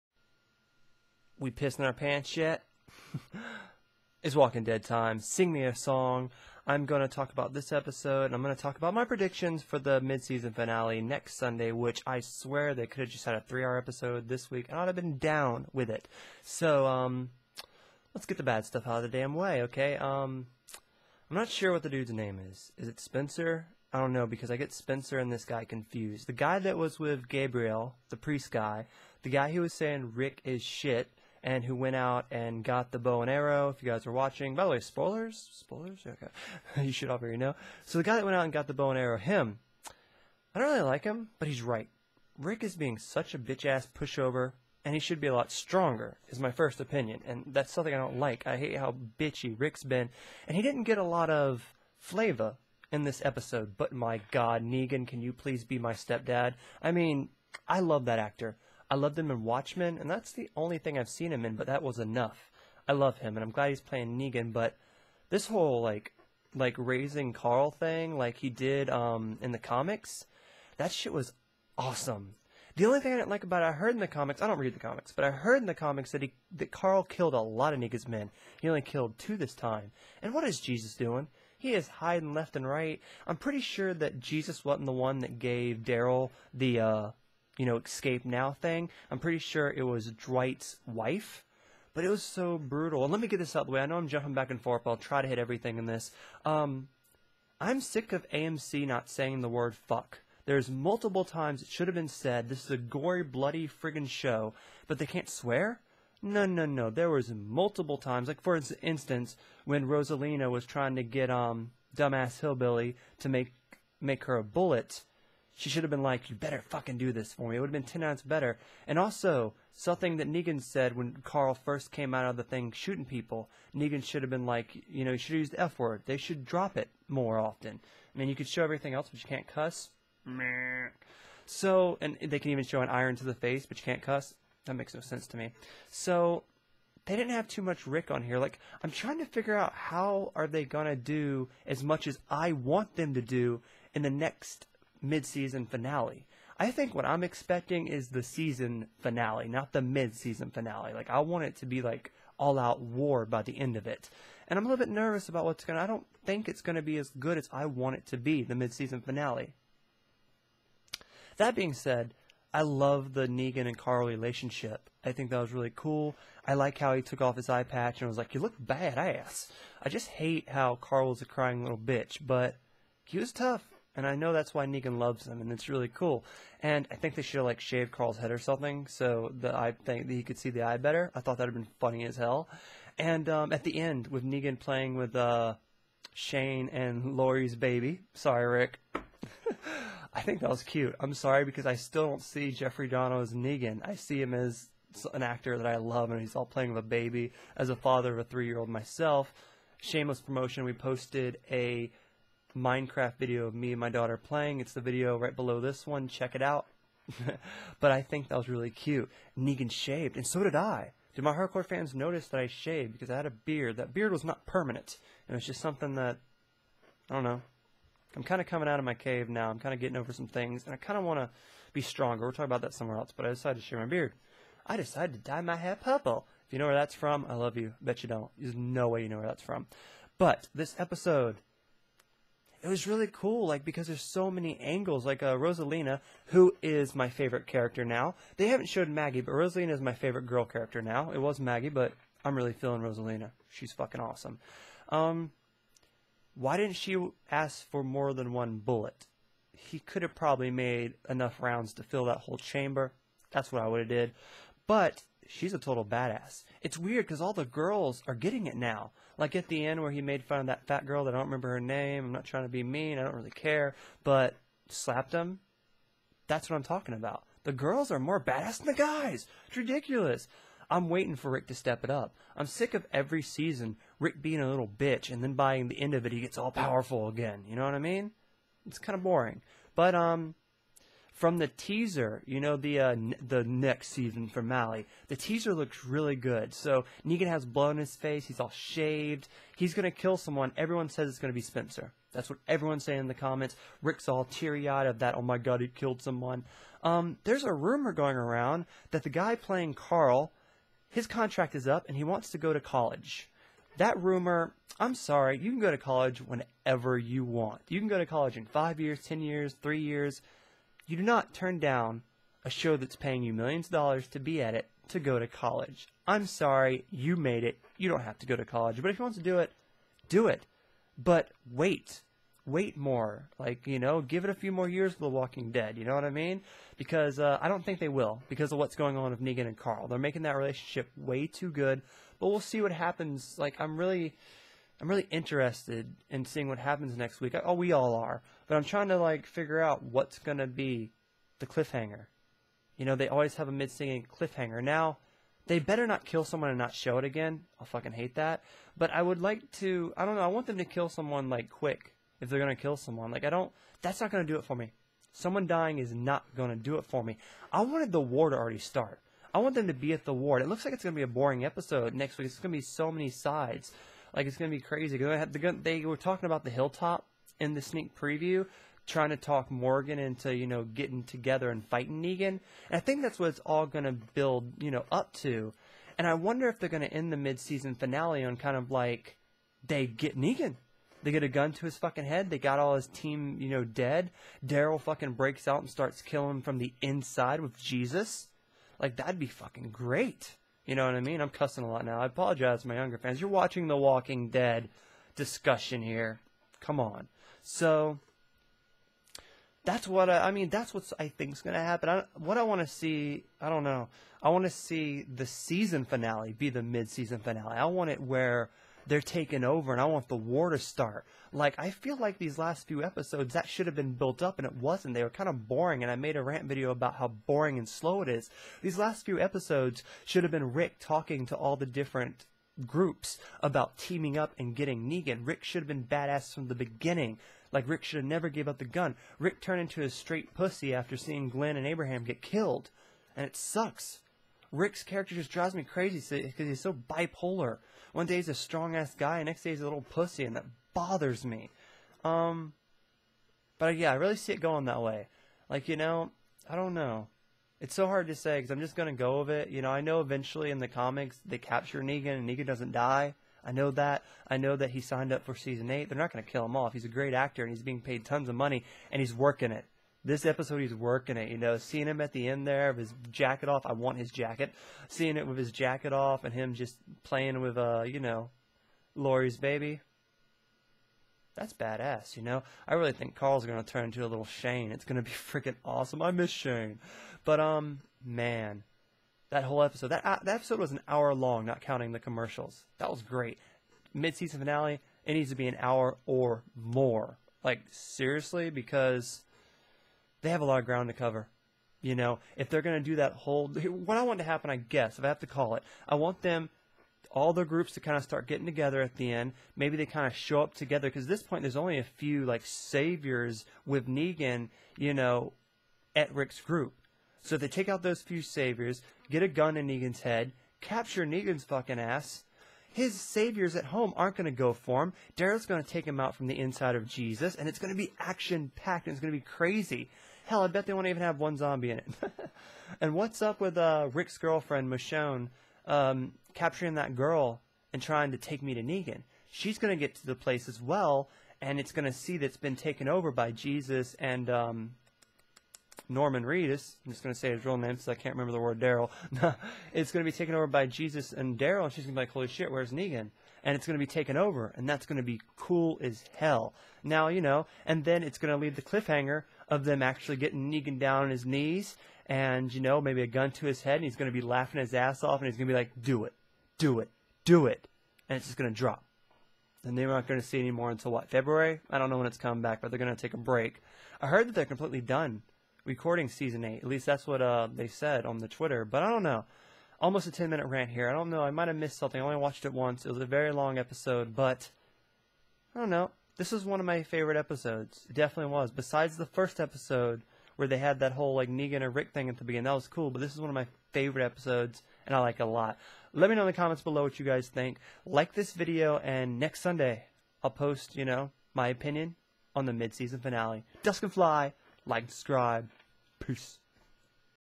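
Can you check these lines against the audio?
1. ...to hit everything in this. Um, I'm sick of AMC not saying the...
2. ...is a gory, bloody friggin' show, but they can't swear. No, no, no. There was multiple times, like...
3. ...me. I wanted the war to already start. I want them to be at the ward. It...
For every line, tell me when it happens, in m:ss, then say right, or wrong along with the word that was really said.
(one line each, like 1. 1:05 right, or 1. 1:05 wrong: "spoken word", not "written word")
1. 1:35 right
2. 1:42 right
3. 5:57 right.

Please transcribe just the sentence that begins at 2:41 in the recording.
That being said, I love the Negan and Carl relationship.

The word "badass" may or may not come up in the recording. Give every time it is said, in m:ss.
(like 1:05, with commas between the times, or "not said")
2:48, 4:15, 4:28, 7:05, 7:51.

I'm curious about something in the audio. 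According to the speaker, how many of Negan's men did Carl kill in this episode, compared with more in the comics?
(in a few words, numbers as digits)
2.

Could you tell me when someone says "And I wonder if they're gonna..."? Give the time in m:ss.
6:15.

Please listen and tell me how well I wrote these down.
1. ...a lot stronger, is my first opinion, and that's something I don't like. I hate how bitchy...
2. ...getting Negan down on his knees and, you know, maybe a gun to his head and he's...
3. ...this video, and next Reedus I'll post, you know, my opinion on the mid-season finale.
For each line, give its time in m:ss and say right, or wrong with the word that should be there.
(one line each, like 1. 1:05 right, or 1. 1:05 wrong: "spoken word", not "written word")
1. 0:45 right
2. 9:10 right
3. 9:48 wrong: "Sunday", not "Reedus".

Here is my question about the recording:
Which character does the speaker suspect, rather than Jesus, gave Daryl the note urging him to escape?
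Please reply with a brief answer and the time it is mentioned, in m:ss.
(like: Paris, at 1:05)
Dwight's wife, at 1:30.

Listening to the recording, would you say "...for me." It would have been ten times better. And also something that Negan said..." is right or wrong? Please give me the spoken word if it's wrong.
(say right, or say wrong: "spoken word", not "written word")
right.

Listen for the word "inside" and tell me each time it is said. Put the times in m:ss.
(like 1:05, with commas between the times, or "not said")
6:26, 8:36.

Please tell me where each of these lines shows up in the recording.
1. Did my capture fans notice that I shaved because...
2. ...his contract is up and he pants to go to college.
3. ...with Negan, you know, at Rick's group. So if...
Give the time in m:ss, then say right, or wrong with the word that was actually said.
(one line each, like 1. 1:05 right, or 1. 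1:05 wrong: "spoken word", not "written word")
1. 3:31 wrong: "hardcore", not "capture"
2. 5:00 wrong: "wants", not "pants"
3. 8:23 right.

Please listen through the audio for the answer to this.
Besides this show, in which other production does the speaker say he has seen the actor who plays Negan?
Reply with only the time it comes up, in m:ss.
0:59.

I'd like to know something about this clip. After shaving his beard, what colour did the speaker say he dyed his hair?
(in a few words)
Purple.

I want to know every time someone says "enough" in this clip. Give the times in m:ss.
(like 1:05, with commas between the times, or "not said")
1:01, 4:11.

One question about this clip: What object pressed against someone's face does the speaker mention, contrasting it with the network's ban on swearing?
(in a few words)
An iron.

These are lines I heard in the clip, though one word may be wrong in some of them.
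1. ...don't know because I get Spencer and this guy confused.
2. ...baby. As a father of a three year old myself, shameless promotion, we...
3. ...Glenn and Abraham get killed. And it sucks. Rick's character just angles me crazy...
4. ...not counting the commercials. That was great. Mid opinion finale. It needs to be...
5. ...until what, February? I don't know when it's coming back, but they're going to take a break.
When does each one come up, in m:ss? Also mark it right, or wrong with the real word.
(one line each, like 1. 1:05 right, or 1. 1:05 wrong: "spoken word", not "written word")
1. 0:23 right
2. 3:16 right
3. 7:11 wrong: "drives", not "angles"
4. 8:01 wrong: "season", not "opinion"
5. 9:20 right.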